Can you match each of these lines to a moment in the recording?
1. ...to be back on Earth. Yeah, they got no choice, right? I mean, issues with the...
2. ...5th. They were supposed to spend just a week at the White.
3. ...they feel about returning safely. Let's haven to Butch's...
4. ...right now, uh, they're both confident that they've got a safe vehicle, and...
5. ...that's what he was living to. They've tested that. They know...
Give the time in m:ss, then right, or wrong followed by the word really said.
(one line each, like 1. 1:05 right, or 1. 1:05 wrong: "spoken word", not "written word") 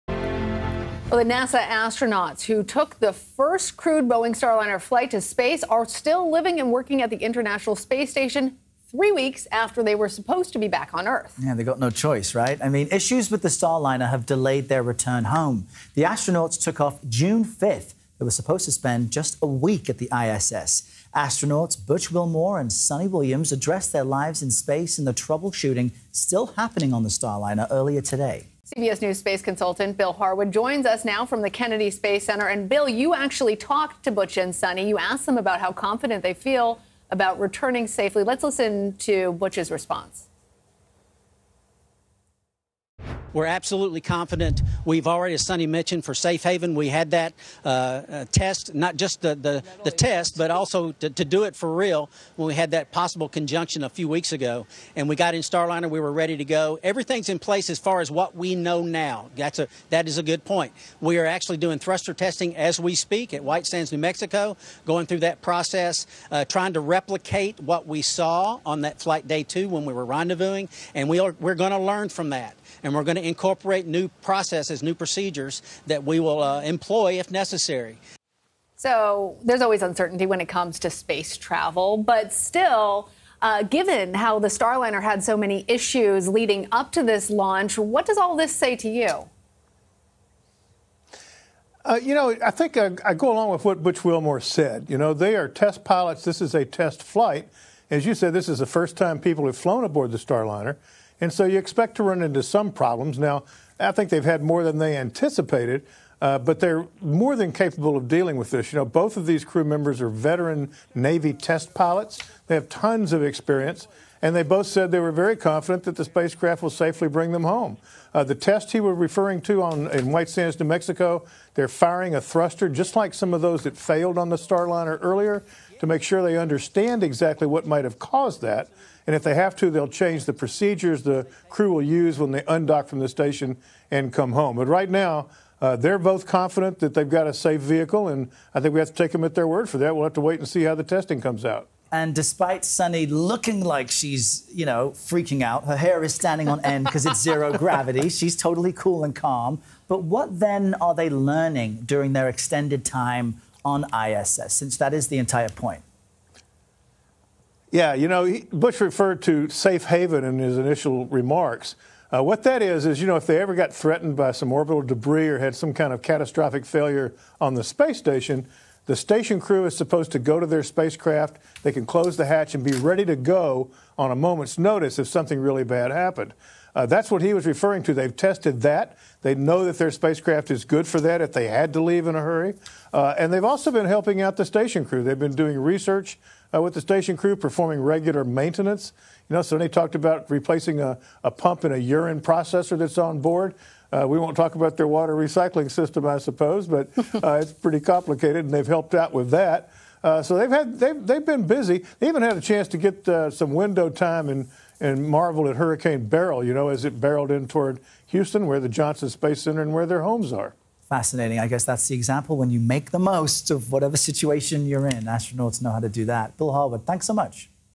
1. 0:10 right
2. 0:17 wrong: "ISS", not "White"
3. 0:36 wrong: "listen", not "haven"
4. 2:14 right
5. 2:56 wrong: "referring", not "living".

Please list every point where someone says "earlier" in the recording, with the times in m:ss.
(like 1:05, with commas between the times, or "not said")
0:27, 2:05.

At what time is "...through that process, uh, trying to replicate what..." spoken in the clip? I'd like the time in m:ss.
1:05.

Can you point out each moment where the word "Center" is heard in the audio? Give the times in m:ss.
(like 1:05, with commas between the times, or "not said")
0:32, 3:29.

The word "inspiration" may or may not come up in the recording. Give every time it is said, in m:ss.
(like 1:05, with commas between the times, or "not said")
not said.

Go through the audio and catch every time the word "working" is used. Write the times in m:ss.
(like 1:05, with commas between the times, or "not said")
0:06.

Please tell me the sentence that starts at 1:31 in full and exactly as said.
Uh, you know, I think I, I, go along with what Butch Wilmore said.